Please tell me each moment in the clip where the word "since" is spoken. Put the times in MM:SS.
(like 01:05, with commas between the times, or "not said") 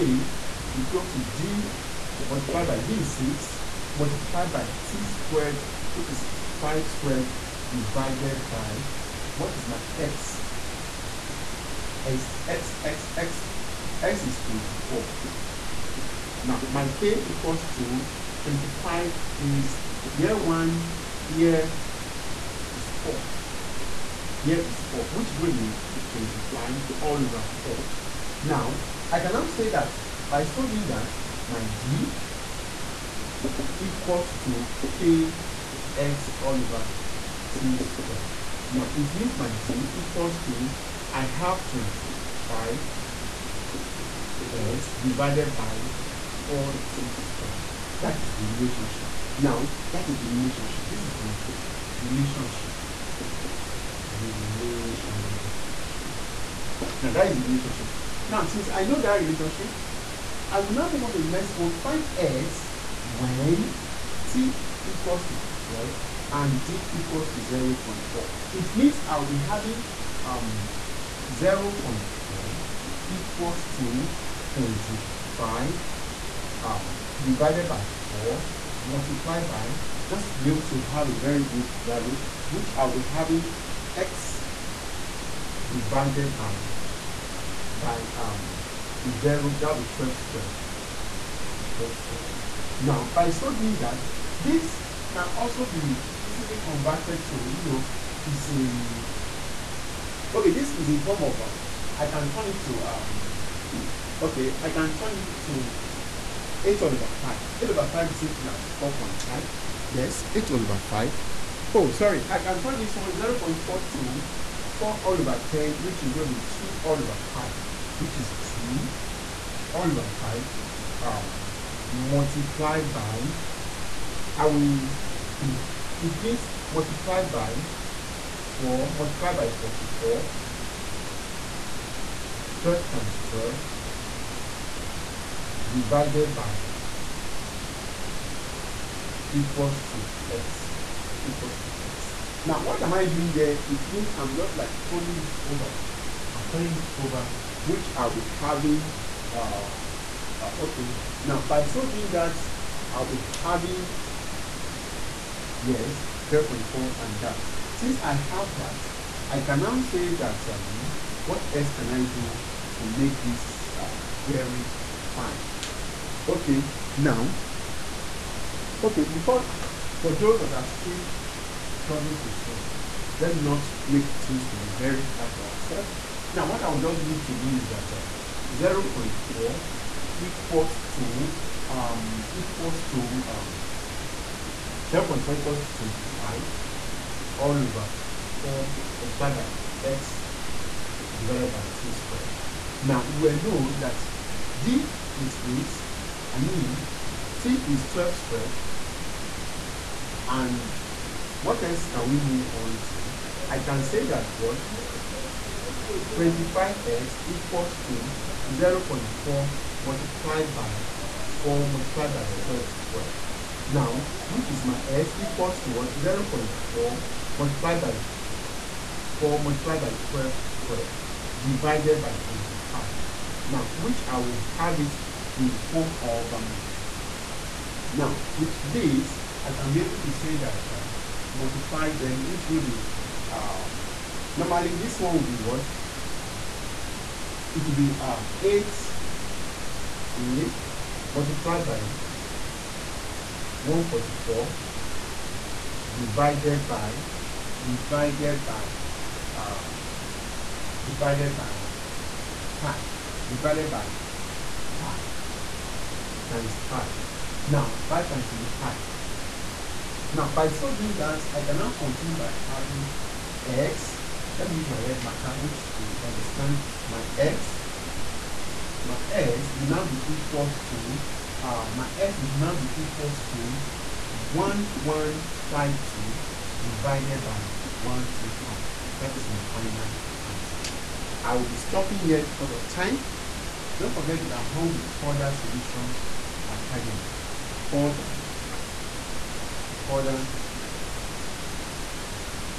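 00:58, 02:37.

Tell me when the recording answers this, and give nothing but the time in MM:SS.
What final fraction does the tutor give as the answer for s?
04:34.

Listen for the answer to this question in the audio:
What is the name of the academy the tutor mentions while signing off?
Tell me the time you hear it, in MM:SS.
04:44.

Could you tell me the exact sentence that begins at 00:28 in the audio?
Now, I can now say that by solving that, my d equals to k x all over t squared.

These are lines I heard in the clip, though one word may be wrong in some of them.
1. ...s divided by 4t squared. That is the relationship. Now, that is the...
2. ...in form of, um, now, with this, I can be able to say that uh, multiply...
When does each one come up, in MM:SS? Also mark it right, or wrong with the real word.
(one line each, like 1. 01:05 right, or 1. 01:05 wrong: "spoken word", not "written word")
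1. 00:44 right
2. 03:45 right.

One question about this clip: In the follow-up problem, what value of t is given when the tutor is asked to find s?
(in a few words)
12.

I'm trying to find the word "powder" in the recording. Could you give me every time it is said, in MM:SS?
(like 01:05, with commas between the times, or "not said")
not said.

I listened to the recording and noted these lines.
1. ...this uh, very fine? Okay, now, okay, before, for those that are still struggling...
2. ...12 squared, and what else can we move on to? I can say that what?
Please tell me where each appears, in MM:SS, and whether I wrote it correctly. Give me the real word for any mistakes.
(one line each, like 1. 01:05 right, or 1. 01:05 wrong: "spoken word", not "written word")
1. 02:43 right
2. 03:17 right.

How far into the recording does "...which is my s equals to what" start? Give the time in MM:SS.
03:34.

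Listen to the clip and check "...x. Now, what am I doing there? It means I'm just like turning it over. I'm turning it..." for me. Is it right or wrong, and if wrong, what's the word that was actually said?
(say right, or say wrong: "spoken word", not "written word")
right.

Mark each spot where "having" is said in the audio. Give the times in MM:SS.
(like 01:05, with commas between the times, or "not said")
01:09, 01:23, 02:28, 02:33, 04:22.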